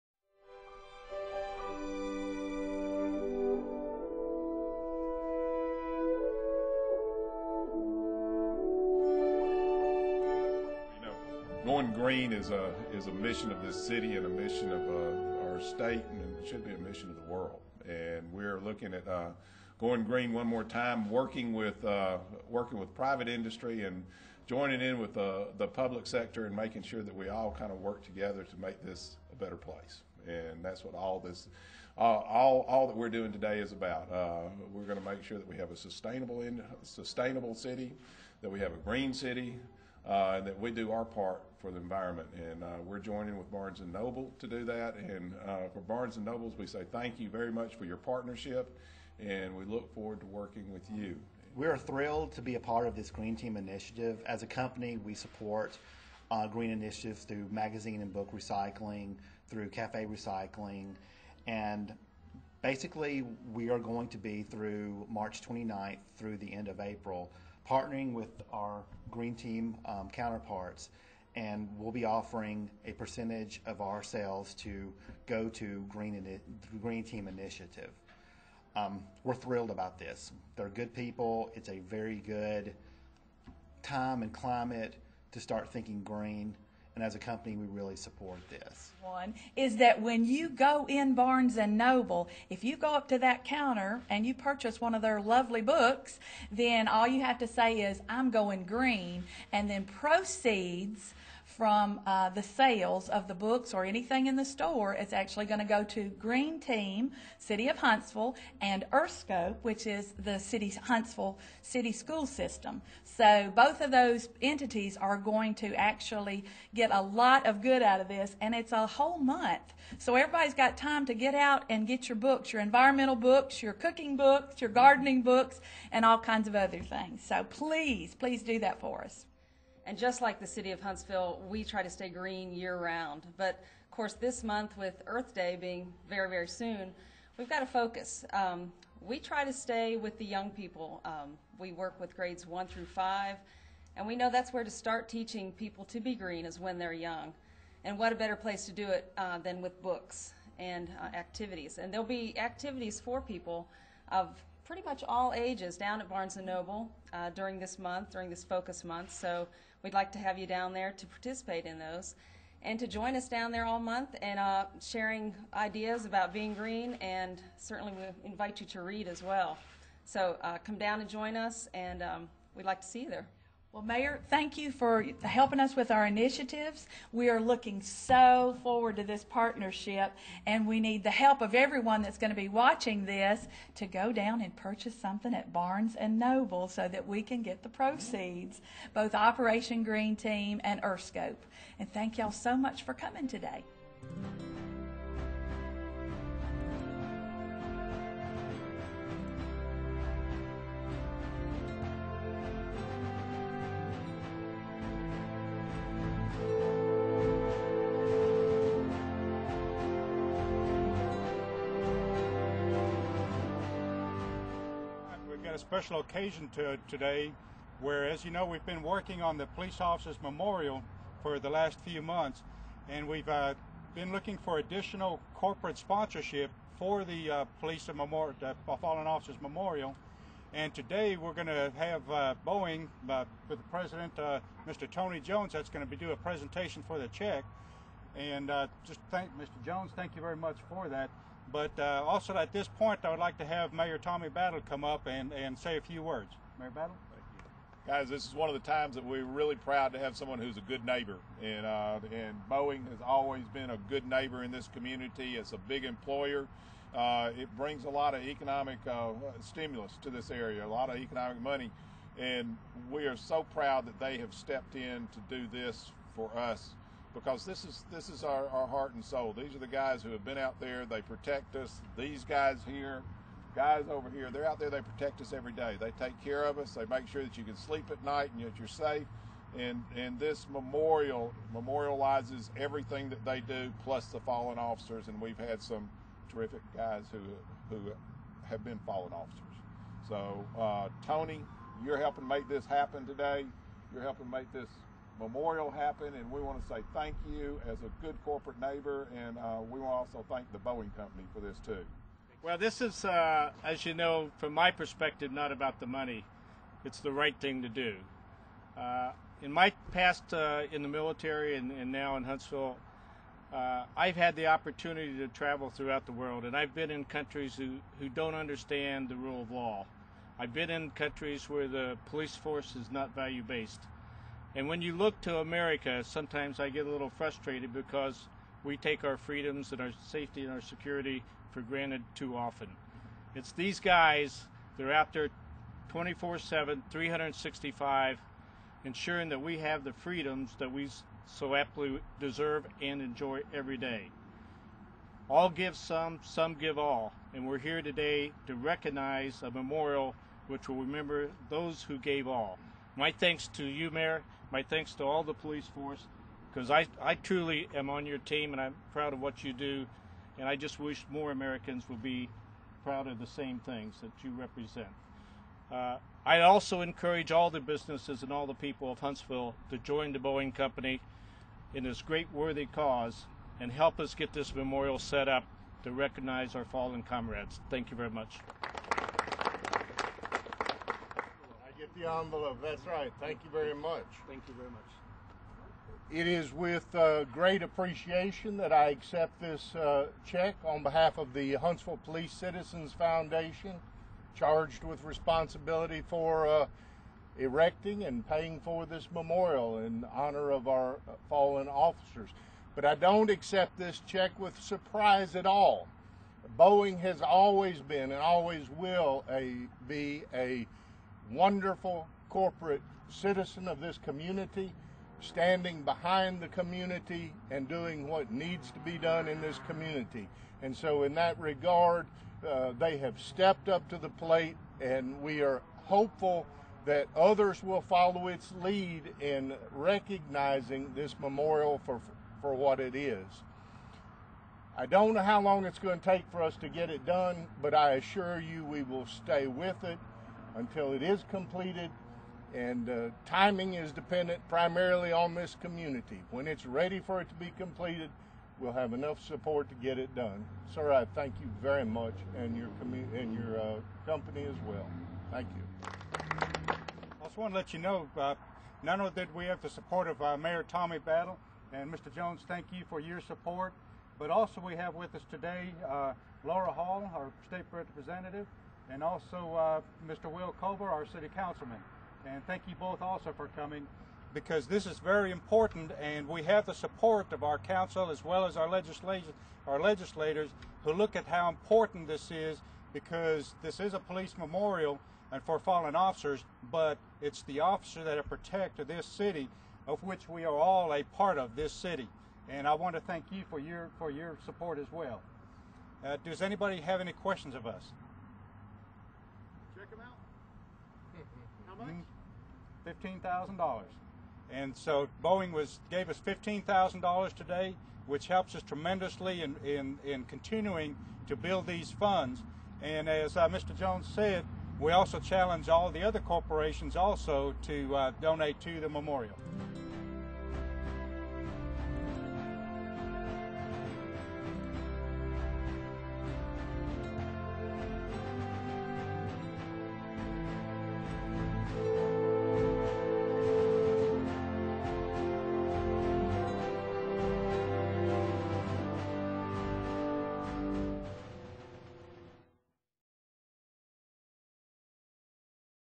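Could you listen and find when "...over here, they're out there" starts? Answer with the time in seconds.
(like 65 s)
273 s.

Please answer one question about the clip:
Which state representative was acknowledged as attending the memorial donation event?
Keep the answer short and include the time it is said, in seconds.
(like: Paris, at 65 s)
Laura Hall, at 466 s.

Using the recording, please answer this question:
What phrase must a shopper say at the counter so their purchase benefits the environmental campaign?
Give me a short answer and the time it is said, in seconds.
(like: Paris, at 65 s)
I'm going green, at 98 s.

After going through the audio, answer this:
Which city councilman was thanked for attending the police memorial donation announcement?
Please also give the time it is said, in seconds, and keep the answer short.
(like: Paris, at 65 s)
Will Culver, at 470 s.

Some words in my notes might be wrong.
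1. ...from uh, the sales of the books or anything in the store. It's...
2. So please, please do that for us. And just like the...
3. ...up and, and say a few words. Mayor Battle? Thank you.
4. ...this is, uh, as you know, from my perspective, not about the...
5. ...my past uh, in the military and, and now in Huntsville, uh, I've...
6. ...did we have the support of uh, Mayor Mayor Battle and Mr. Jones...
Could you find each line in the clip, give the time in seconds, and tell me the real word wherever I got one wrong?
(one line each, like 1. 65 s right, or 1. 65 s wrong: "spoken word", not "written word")
1. 101 s right
2. 127 s right
3. 244 s right
4. 302 s right
5. 309 s right
6. 459 s wrong: "Tommy", not "Mayor".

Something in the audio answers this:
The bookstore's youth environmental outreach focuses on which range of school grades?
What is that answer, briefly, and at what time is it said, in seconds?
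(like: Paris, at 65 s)
Grades 1 through 5, at 142 s.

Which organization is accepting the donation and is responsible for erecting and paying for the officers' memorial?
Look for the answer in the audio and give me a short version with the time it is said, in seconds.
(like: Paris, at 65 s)
Huntsville Police Citizens Foundation, at 391 s.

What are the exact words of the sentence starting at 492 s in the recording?
And I want to thank you for your, for your support as well.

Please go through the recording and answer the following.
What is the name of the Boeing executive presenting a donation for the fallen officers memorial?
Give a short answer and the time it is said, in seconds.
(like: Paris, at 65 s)
Tony Jones, at 234 s.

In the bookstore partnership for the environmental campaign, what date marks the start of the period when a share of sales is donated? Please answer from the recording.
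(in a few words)
March 29th.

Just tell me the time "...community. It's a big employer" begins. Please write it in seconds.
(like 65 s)
254 s.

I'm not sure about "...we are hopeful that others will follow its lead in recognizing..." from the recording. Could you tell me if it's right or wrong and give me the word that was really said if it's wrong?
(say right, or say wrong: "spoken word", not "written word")
right.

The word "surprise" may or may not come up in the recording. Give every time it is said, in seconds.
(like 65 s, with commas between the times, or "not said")
404 s.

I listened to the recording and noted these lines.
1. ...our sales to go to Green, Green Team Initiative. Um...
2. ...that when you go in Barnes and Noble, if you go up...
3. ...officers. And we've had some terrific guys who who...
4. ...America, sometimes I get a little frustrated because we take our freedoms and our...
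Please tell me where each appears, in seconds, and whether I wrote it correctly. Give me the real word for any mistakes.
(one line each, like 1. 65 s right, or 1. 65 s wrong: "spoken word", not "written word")
1. 73 s right
2. 89 s right
3. 284 s right
4. 325 s right.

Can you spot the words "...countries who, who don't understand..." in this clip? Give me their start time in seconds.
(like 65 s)
317 s.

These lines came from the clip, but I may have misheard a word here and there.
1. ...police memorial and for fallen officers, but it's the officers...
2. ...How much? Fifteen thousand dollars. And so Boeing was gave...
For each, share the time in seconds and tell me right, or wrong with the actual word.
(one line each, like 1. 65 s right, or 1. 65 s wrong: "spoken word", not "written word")
1. 483 s right
2. 501 s right.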